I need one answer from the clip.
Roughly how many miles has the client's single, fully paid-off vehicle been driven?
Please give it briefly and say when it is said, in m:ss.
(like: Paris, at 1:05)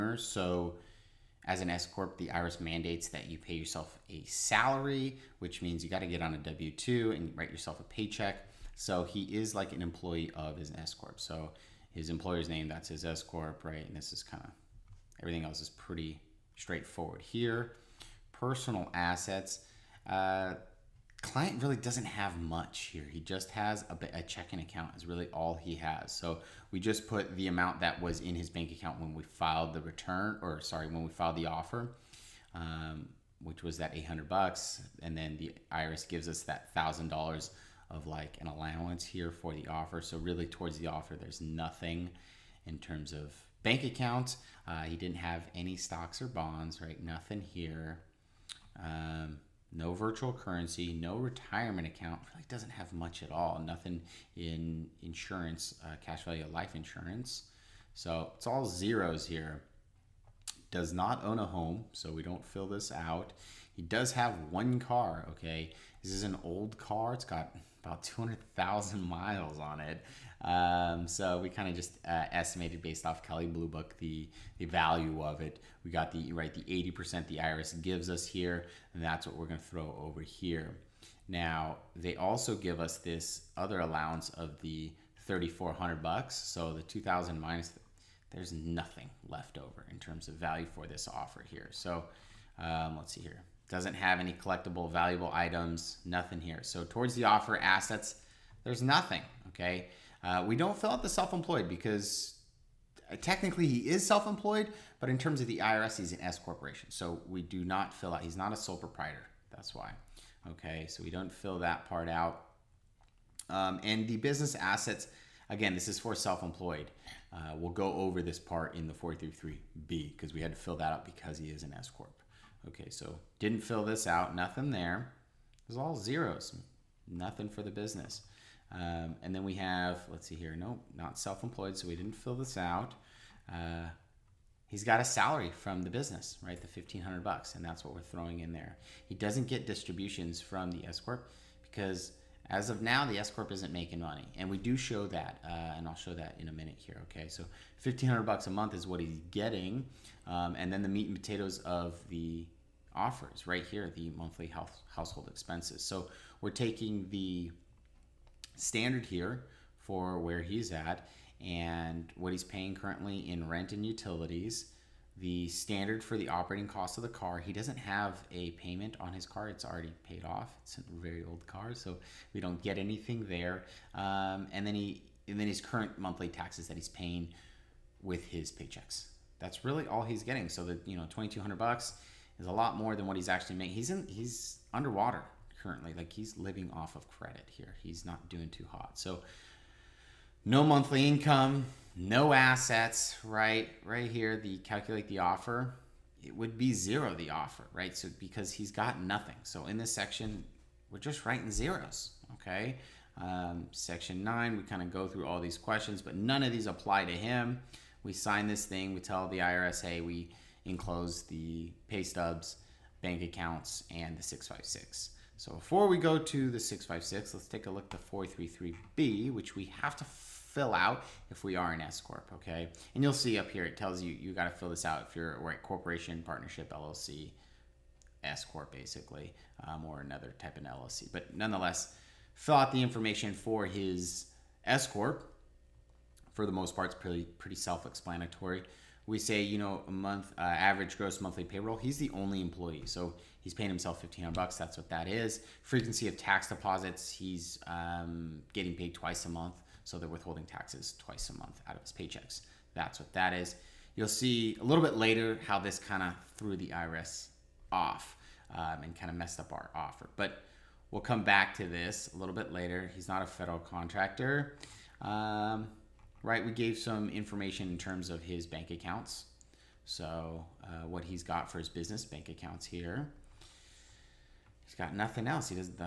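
200,000, at 1:08.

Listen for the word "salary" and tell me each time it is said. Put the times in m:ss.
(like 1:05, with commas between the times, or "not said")
0:04, 2:15.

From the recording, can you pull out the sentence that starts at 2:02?
Okay, so didn't fill this out, nothing there.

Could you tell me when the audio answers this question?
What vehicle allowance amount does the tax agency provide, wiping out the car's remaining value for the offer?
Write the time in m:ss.
1:25.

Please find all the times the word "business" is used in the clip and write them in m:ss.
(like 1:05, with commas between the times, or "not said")
1:54, 2:07, 2:15, 4:31.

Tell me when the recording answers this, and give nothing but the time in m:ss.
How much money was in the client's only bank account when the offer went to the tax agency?
0:33.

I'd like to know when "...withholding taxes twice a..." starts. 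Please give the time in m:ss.
4:10.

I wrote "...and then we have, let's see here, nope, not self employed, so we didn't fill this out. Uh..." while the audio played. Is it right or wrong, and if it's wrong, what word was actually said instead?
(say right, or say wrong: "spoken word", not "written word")
right.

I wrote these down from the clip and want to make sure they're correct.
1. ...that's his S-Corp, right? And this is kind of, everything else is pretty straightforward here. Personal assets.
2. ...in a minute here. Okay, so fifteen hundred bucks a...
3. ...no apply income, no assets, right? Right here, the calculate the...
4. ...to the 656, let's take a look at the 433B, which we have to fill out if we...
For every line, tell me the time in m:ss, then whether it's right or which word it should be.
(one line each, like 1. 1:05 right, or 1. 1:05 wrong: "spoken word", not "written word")
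1. 0:12 right
2. 2:26 right
3. 3:10 wrong: "monthly", not "apply"
4. 3:36 right.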